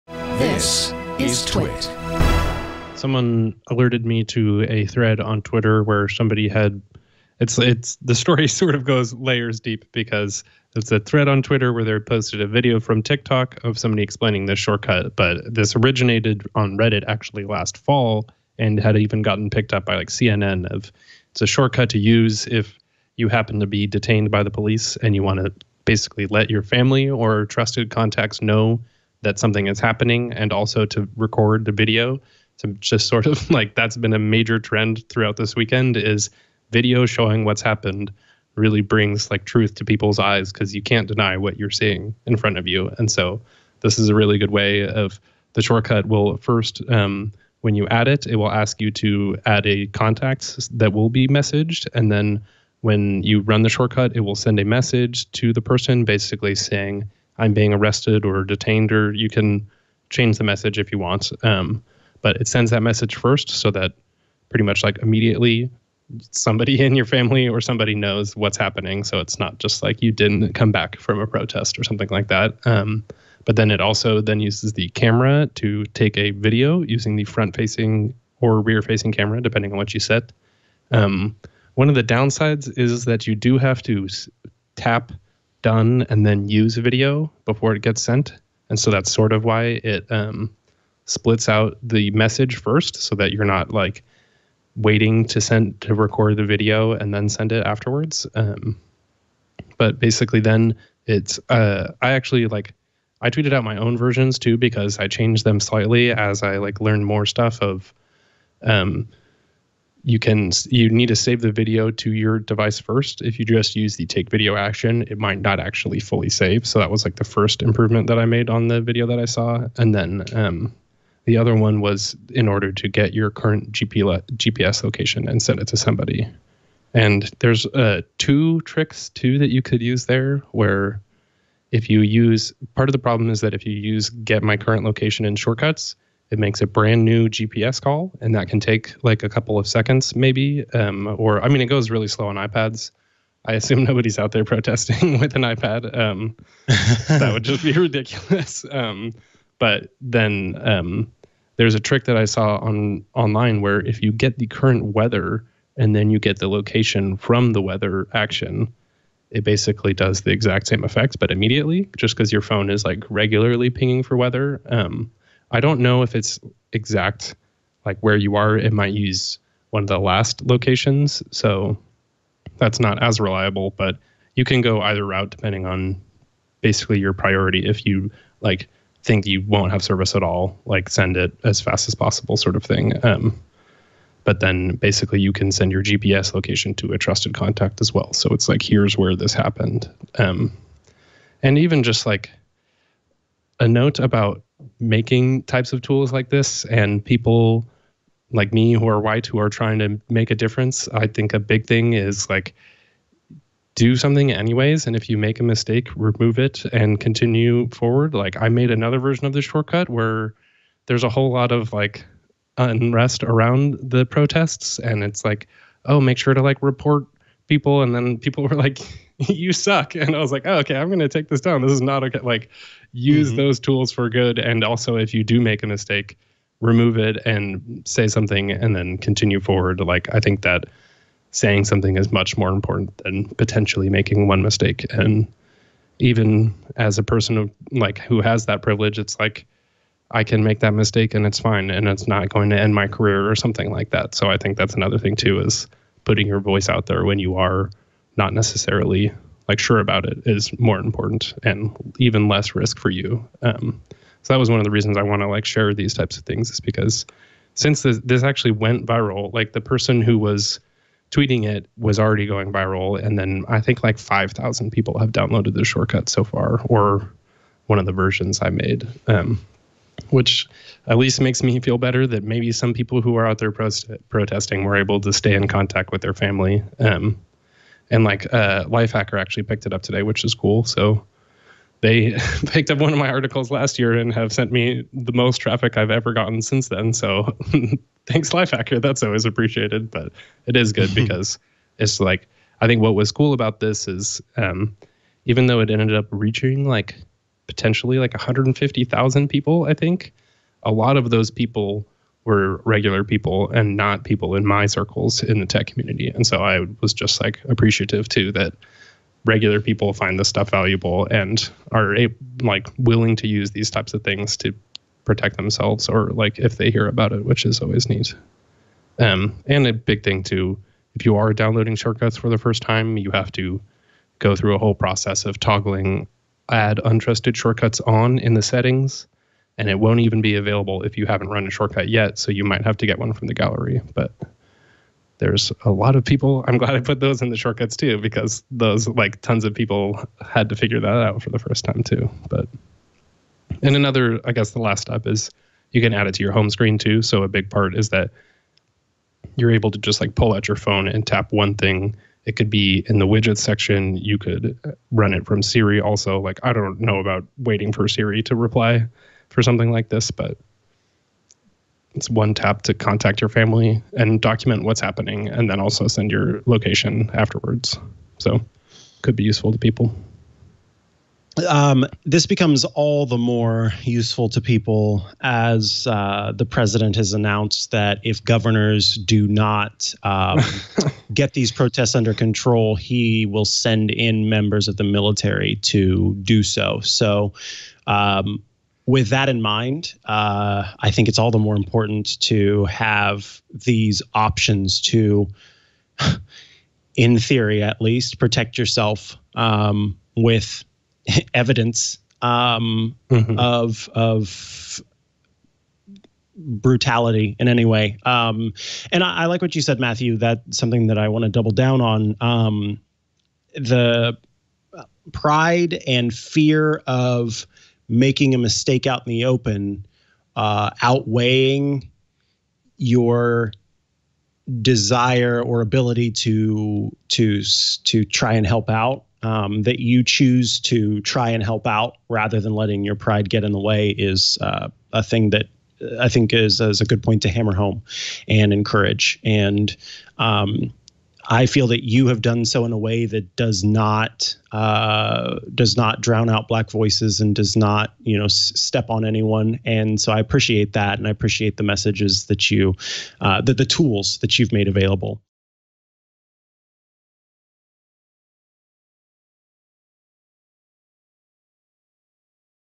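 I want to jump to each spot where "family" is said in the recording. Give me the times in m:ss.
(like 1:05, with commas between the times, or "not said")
0:26, 1:07, 4:36, 6:03.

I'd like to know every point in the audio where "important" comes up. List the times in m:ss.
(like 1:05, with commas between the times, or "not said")
3:52, 4:10, 6:31.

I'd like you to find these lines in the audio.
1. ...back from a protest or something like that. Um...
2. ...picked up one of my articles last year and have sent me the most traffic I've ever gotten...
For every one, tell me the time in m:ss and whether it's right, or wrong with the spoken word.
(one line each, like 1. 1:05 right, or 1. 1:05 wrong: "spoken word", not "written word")
1. 1:10 right
2. 4:42 right.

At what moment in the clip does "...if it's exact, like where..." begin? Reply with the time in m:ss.
2:46.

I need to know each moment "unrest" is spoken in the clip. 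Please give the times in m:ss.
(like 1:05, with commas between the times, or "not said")
3:32.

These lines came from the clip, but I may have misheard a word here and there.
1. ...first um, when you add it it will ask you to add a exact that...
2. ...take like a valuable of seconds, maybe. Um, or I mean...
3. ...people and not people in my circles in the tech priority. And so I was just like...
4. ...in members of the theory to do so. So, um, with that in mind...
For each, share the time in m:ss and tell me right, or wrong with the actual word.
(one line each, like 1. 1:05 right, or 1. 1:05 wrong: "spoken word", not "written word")
1. 0:46 wrong: "contact", not "exact"
2. 2:18 wrong: "couple", not "valuable"
3. 5:03 wrong: "community", not "priority"
4. 6:23 wrong: "military", not "theory".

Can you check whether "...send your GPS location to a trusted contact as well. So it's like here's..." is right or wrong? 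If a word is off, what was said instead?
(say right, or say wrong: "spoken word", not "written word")
right.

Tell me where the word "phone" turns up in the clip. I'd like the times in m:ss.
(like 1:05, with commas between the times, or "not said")
2:42, 5:50.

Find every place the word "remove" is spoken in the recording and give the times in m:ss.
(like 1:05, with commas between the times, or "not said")
3:25, 3:46.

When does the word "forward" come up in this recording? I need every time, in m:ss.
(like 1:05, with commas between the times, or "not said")
3:27, 3:49.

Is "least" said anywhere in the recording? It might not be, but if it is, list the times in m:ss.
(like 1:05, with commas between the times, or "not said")
4:30, 6:37.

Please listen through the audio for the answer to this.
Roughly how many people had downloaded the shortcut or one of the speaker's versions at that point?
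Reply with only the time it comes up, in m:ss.
4:23.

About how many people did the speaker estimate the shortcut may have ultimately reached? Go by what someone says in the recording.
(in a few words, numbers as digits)
150,000.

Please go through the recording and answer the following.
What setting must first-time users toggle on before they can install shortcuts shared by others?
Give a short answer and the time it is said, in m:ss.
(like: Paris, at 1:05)
add untrusted shortcuts, at 5:26.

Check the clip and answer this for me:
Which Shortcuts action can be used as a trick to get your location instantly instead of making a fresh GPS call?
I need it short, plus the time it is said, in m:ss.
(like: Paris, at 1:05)
get the current weather, at 2:34.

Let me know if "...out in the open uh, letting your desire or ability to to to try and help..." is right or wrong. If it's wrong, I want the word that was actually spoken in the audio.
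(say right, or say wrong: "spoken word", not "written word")
wrong: "outweighing", not "letting".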